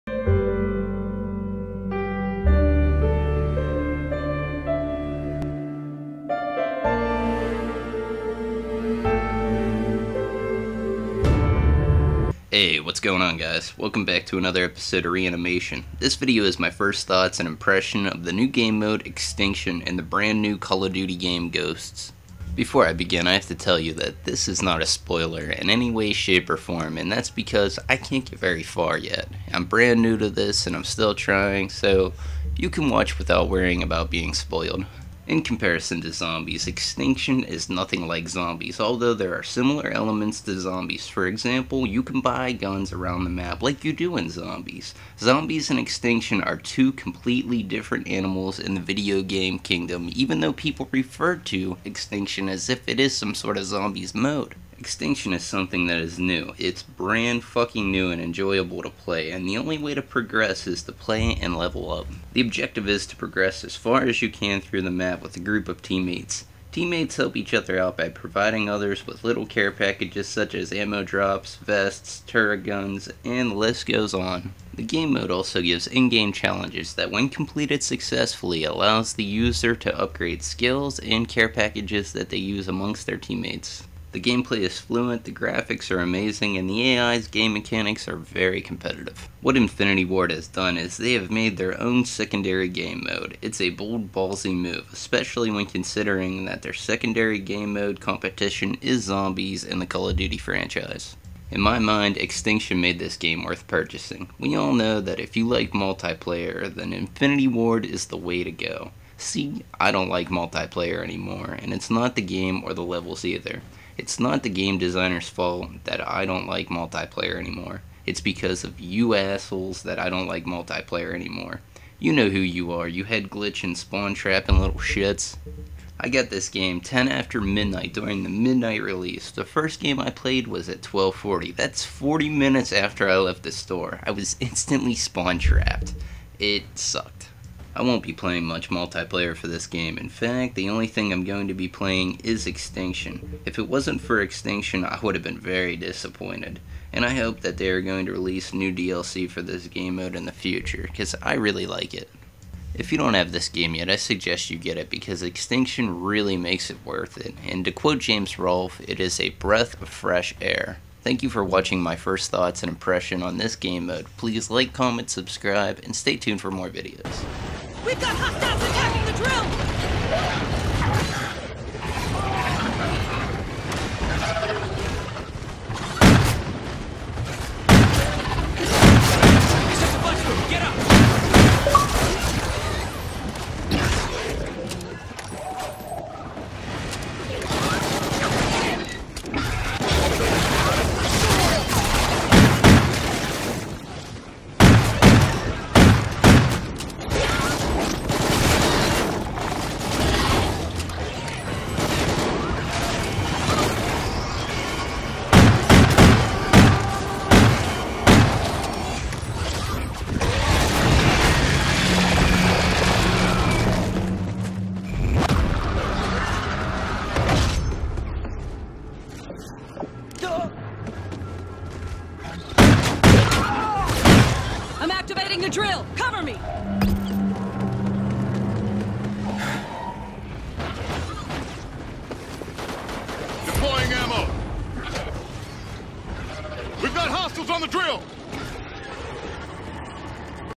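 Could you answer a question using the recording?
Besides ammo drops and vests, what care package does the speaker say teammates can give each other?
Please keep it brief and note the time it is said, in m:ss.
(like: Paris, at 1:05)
turret guns, at 1:12.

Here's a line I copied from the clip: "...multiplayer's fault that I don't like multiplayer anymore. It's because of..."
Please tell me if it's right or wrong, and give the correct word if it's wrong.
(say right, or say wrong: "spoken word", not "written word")
wrong: "designer", not "multiplayer".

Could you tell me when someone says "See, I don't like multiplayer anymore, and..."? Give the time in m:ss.
1:49.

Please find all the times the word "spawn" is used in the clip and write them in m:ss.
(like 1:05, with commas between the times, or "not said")
2:03, 2:14.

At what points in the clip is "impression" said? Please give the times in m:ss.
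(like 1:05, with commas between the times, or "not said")
0:17, 2:42.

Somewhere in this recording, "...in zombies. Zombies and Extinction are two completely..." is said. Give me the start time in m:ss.
0:44.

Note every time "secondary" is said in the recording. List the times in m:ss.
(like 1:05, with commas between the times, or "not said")
1:32, 1:36.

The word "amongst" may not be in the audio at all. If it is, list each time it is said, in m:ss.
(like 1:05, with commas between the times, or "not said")
1:22.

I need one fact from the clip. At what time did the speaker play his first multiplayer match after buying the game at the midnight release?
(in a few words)
12:40.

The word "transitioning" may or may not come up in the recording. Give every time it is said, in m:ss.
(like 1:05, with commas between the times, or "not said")
not said.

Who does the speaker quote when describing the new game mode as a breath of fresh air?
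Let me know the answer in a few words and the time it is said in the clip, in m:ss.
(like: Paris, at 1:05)
James Rolfe, at 2:37.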